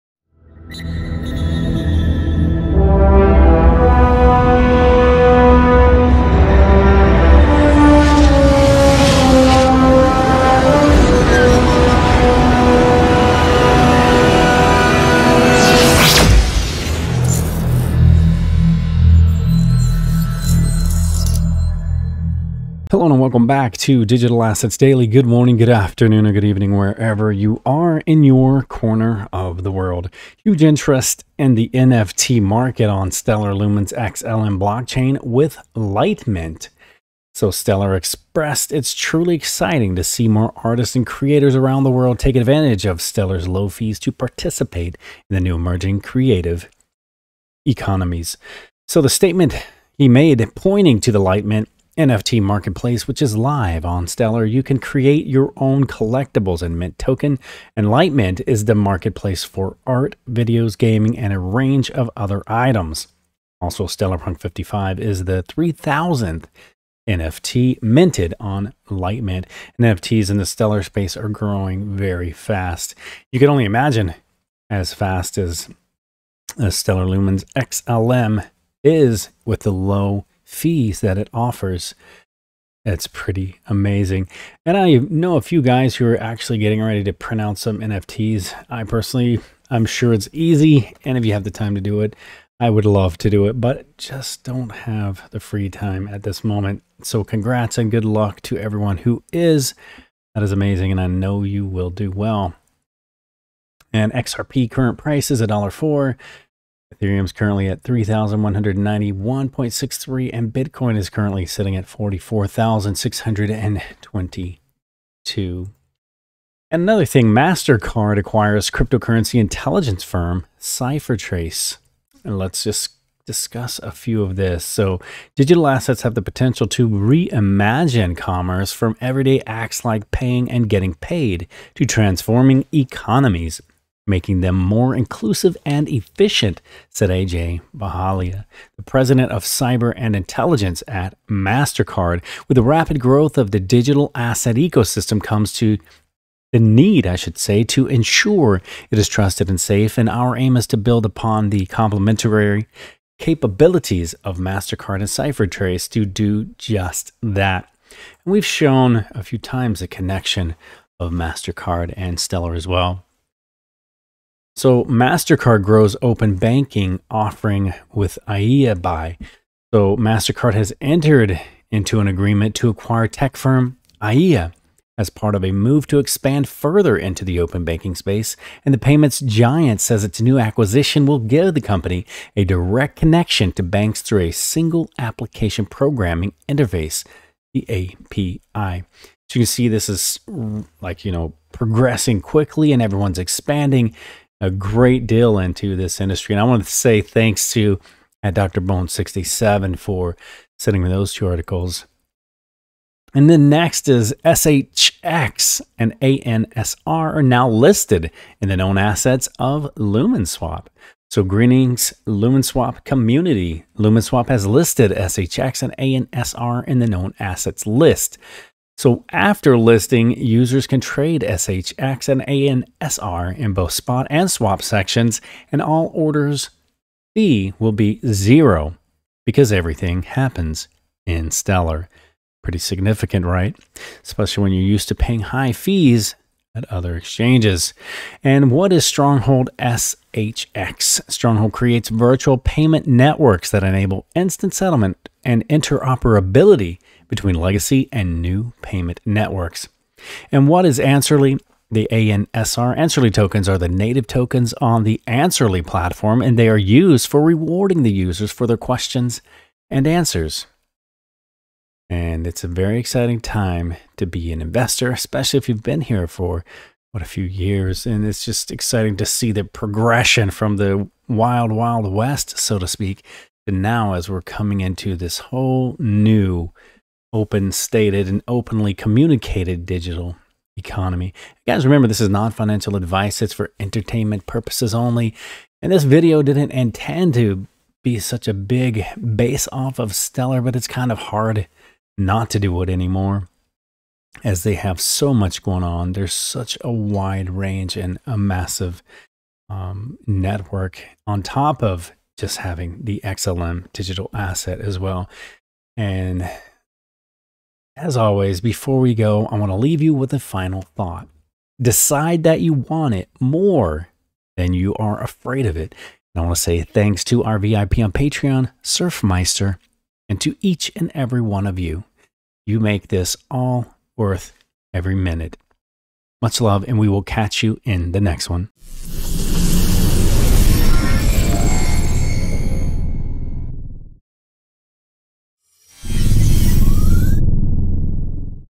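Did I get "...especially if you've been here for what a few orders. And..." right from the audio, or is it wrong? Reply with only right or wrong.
wrong.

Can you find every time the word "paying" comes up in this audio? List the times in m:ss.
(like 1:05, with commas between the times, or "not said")
2:10, 3:54.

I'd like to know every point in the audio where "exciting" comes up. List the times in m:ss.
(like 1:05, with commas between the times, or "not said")
0:39, 4:22, 4:28.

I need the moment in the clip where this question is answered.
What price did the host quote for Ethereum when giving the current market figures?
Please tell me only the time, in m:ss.
1:47.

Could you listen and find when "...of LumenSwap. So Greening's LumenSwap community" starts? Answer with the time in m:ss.
3:29.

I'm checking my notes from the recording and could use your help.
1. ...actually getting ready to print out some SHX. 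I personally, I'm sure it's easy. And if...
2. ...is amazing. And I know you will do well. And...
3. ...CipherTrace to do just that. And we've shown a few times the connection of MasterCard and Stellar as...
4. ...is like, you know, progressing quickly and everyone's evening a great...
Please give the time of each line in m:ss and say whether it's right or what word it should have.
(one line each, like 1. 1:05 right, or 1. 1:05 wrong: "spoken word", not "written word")
1. 1:26 wrong: "NFTs", not "SHX"
2. 1:40 right
3. 2:35 right
4. 3:09 wrong: "expanding", not "evening".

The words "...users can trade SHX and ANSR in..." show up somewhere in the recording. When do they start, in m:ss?
3:40.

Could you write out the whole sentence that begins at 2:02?
And let's just discuss a few of this.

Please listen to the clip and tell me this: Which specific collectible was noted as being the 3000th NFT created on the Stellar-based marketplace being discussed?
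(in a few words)
Stellar Punk 55.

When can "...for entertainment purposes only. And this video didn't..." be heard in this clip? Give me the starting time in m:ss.
4:43.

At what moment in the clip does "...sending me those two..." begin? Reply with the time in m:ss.
3:20.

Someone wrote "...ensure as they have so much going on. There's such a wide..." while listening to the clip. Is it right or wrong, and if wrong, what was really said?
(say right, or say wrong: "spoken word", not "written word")
wrong: "anymore", not "ensure".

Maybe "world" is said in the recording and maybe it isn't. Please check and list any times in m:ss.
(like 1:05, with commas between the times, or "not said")
0:29, 0:41.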